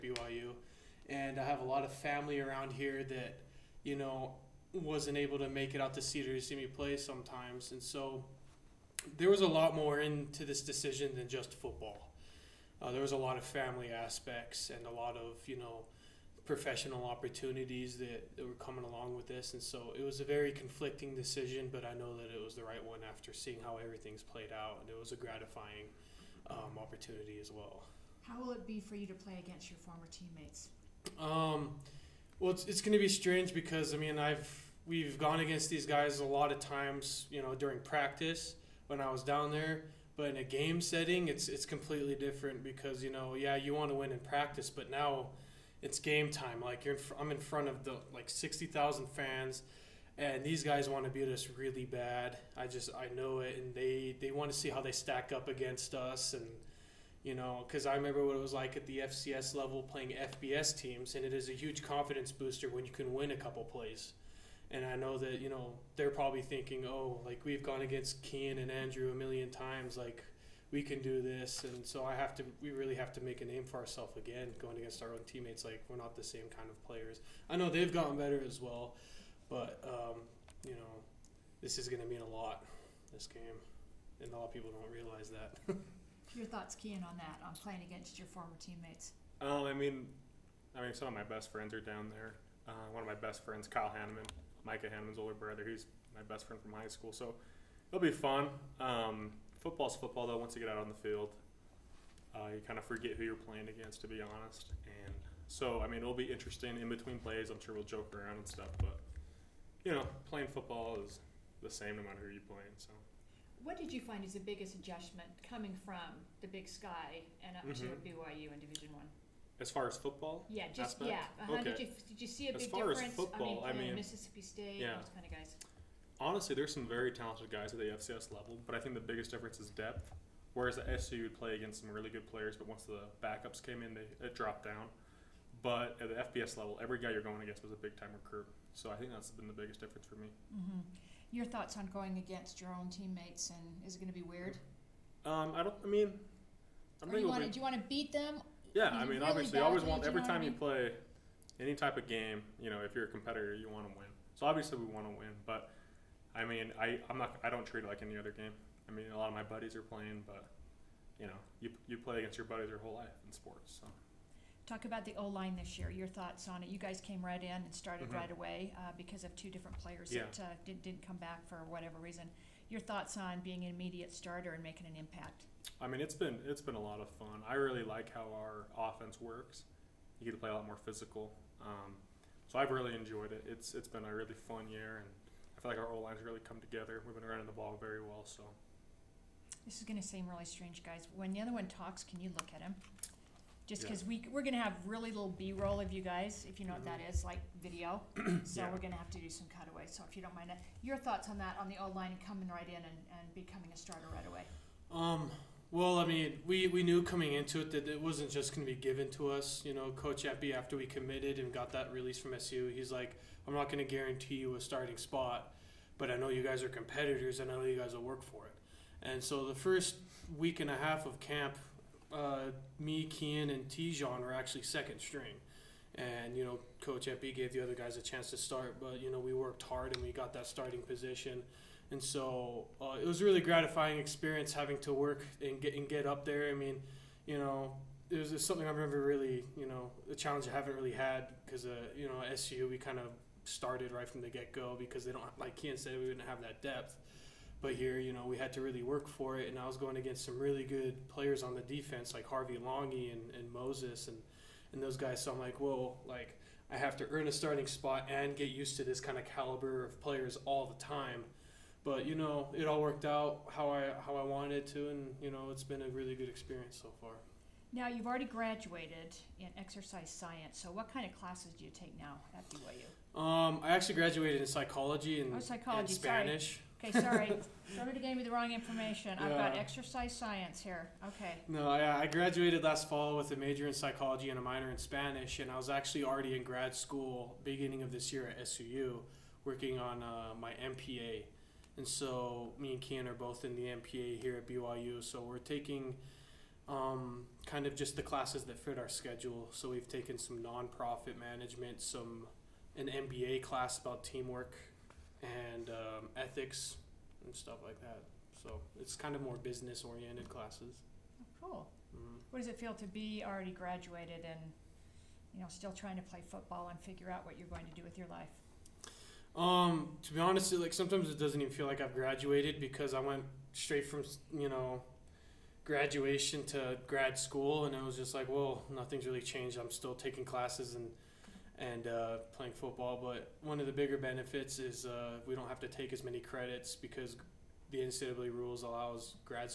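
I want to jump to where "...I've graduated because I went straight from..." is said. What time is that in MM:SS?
05:21.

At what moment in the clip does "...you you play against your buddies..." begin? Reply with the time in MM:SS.
02:41.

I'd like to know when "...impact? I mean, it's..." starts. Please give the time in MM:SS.
02:54.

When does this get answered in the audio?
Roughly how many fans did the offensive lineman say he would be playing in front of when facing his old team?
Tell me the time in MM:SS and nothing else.
00:48.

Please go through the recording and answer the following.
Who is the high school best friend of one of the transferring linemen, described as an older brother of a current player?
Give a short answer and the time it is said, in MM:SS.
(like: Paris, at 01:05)
Kyle Hannemann, at 01:33.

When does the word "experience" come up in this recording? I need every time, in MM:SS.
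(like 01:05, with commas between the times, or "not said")
03:53, 04:26.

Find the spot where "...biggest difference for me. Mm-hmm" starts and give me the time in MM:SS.
02:19.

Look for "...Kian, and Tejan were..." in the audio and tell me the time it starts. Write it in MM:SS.
03:43.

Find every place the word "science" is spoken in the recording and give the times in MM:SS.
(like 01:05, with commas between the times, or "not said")
04:30, 04:40.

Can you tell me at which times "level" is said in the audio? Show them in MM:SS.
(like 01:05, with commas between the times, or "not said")
00:59, 02:08, 02:16.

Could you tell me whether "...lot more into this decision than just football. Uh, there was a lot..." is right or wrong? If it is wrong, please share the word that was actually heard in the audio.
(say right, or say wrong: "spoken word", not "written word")
right.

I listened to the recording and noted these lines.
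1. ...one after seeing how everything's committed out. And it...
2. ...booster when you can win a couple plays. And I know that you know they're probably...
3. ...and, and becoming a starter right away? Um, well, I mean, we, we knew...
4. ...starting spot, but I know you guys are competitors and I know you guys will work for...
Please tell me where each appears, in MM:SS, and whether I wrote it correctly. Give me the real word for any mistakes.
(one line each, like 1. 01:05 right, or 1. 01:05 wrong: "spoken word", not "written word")
1. 00:22 wrong: "played", not "committed"
2. 01:02 right
3. 03:22 right
4. 03:34 right.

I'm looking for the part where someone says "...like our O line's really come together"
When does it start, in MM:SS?
03:05.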